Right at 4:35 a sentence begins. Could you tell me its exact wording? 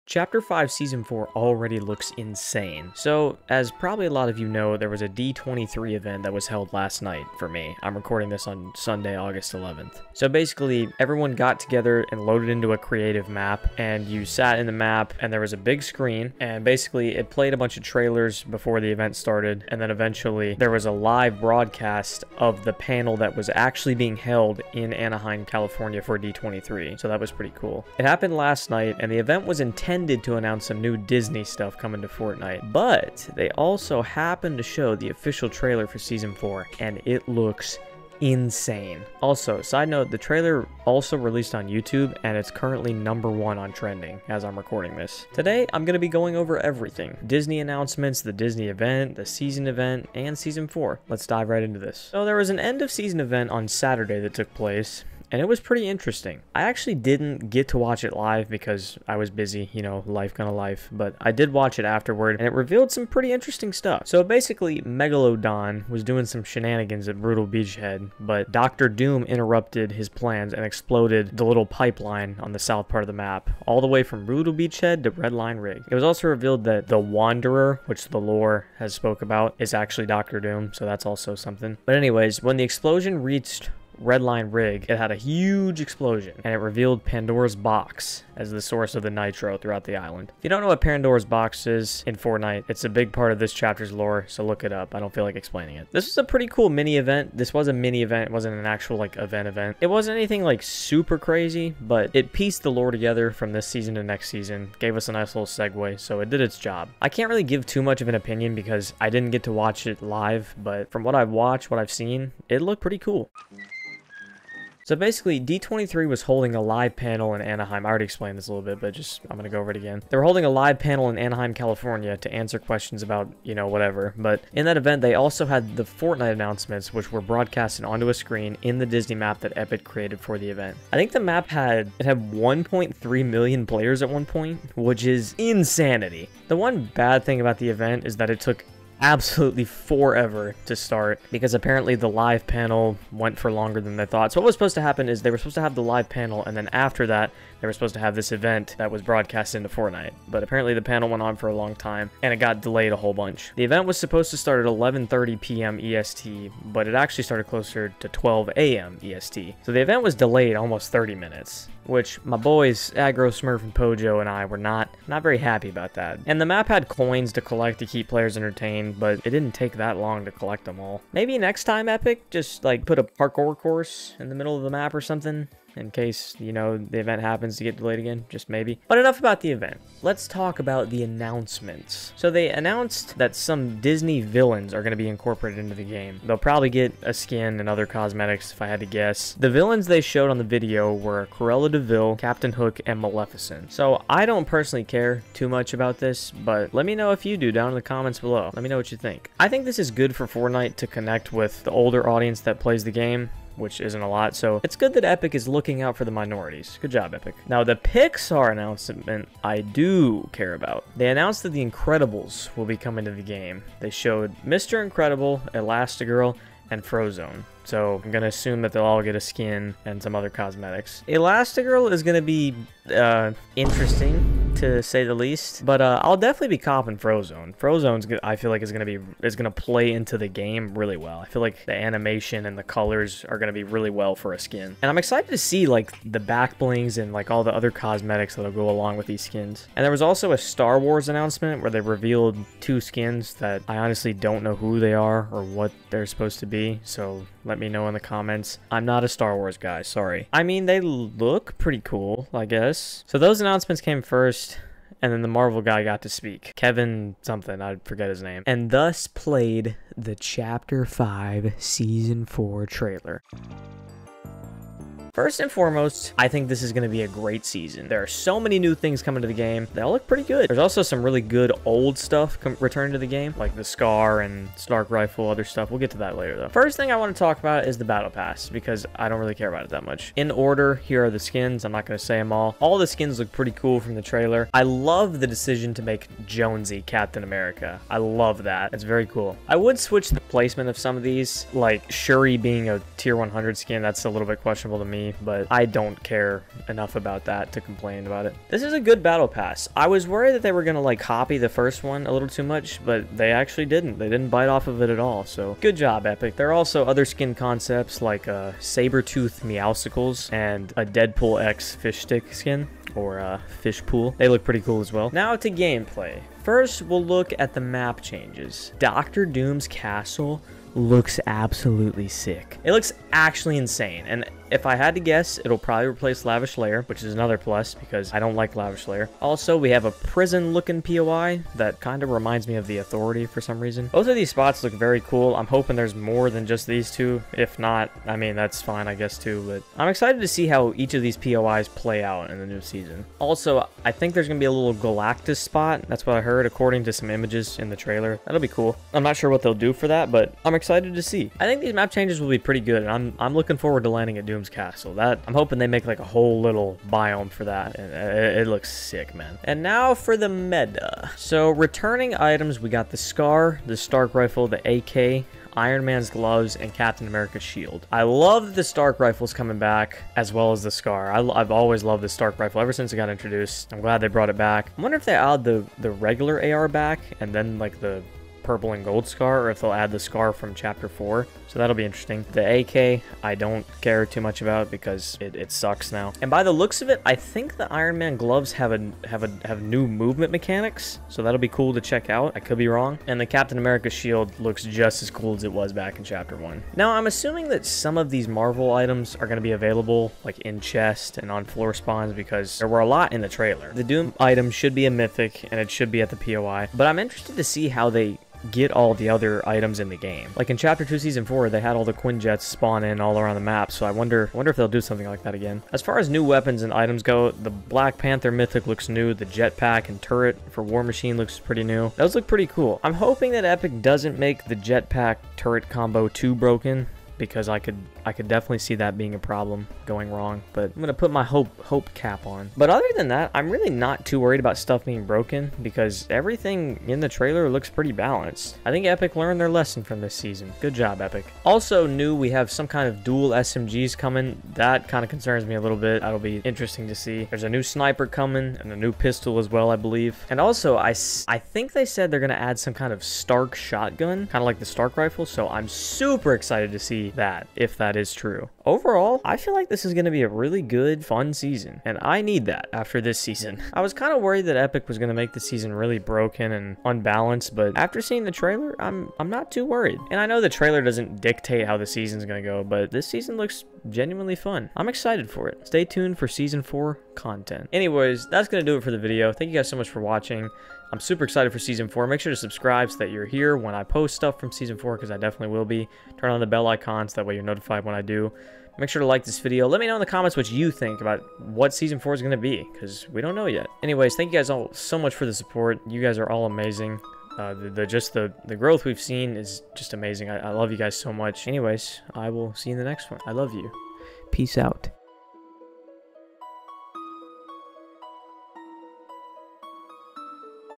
We'll get to that later, though.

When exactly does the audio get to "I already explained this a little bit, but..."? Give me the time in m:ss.
1:57.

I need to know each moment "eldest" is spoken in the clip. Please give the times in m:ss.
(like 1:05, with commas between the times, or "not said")
not said.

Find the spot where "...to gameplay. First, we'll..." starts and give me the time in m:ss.
5:15.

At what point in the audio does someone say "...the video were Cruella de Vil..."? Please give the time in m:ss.
3:10.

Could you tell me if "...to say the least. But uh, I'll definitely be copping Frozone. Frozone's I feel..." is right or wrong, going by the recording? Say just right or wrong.
right.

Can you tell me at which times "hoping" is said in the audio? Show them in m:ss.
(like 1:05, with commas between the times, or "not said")
5:35, 5:55, 7:02.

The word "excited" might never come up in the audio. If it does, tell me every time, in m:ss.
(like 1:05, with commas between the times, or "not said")
3:54, 5:39, 5:50, 7:36, 7:54, 8:01.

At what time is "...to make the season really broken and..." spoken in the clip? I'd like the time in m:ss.
7:45.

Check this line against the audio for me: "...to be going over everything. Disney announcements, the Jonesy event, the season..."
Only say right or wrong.
wrong.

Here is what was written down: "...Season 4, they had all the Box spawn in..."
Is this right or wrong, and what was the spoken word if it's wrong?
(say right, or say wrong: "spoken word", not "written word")
wrong: "Quinjets", not "Box".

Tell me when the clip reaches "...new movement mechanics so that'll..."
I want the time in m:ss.
6:29.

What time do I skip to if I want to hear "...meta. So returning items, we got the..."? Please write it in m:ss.
6:00.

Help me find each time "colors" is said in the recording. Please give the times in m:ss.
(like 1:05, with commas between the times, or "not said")
3:52.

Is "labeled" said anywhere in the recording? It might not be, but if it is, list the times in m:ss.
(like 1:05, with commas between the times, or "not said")
not said.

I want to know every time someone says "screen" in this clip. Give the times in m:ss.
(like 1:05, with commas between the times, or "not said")
0:15, 2:08.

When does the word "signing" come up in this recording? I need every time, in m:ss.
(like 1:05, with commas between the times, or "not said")
not said.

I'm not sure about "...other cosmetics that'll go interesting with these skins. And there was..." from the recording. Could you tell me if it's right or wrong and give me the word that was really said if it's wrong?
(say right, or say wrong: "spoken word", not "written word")
wrong: "along", not "interesting".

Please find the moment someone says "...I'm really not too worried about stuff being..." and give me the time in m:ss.
7:13.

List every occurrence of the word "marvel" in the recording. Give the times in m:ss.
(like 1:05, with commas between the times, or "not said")
4:15, 6:38.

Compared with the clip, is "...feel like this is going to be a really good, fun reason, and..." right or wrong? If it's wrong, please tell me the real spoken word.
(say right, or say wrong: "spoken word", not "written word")
wrong: "season", not "reason".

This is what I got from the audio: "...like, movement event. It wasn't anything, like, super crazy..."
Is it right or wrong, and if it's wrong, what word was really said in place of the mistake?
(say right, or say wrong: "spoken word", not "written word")
wrong: "event", not "movement".